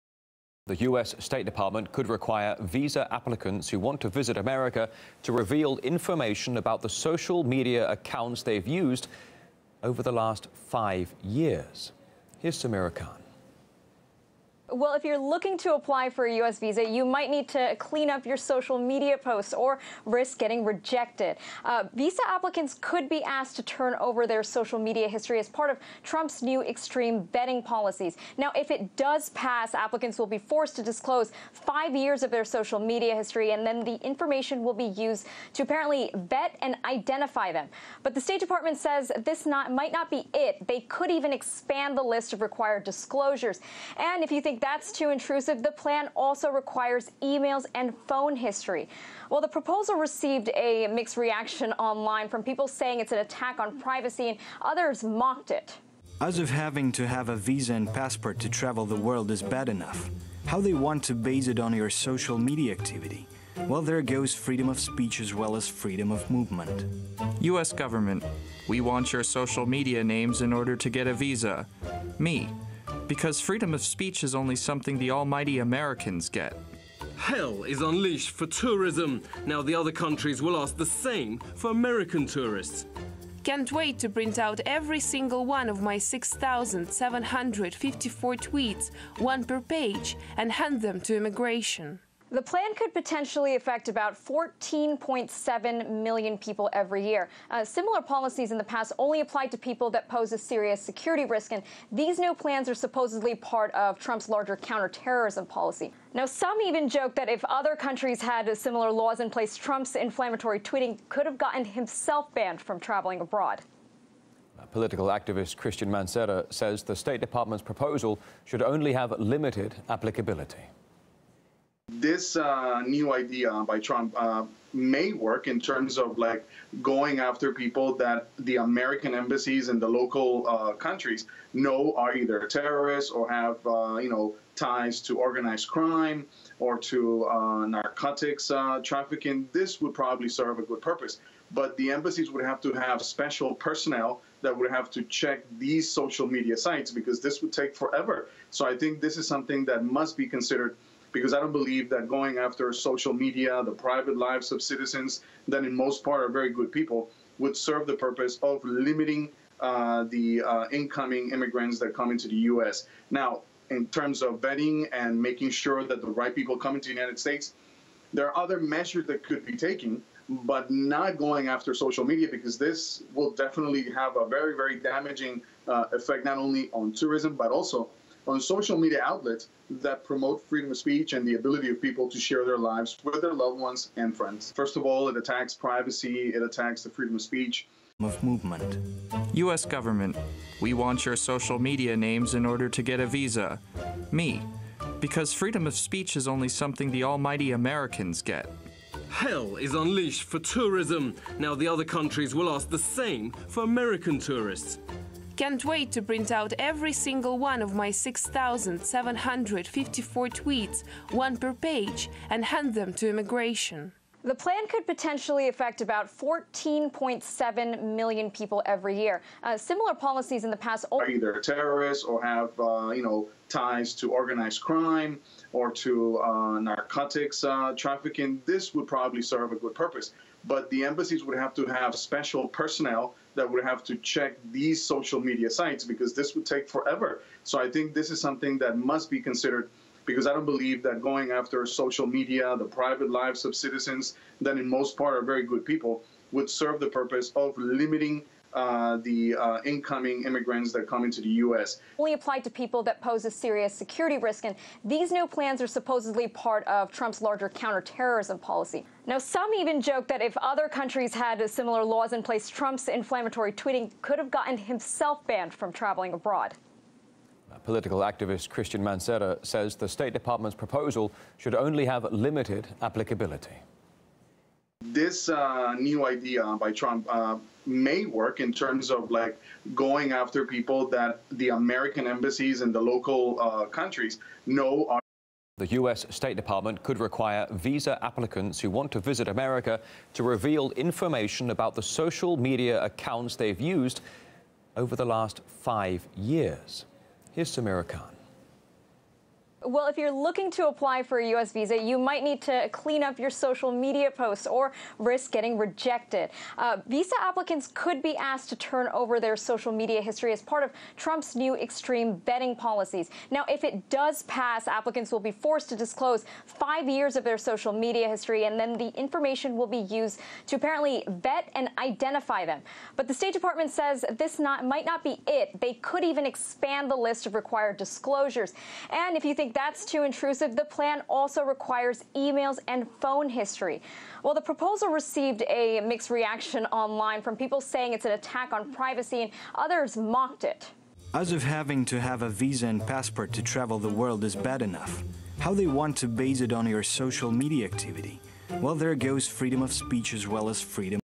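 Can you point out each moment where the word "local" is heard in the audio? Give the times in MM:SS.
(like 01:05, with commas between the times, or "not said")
02:09, 04:42.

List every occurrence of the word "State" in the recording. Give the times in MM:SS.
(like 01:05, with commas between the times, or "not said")
00:01, 00:38, 01:56, 02:47, 04:29, 04:46, 05:23.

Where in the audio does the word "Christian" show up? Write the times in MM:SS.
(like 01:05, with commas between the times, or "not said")
01:55, 04:28.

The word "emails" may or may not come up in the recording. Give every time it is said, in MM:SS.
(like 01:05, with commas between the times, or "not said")
00:47, 05:32.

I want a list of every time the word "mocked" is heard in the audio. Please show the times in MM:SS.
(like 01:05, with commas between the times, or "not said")
00:55, 05:39.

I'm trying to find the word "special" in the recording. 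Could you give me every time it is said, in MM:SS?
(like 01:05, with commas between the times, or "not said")
02:23, 03:51.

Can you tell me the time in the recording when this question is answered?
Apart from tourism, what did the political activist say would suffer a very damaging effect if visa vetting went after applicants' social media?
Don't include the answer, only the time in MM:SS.
02:58.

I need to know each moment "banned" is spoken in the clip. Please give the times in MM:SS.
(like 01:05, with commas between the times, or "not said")
01:52, 04:25.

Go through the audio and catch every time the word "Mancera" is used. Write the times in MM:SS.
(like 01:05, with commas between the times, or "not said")
01:55, 04:28.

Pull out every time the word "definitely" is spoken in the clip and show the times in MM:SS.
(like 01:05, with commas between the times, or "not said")
02:53.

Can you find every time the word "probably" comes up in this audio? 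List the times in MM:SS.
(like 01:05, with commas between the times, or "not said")
02:19, 03:48.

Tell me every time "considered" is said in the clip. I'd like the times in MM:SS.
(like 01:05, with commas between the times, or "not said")
02:30, 03:59.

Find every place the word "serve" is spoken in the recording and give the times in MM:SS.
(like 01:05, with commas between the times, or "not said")
02:20, 02:37, 03:49, 04:06.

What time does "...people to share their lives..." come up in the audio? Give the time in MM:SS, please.
03:01.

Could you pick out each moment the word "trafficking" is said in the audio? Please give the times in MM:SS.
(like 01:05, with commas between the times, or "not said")
02:18, 03:47.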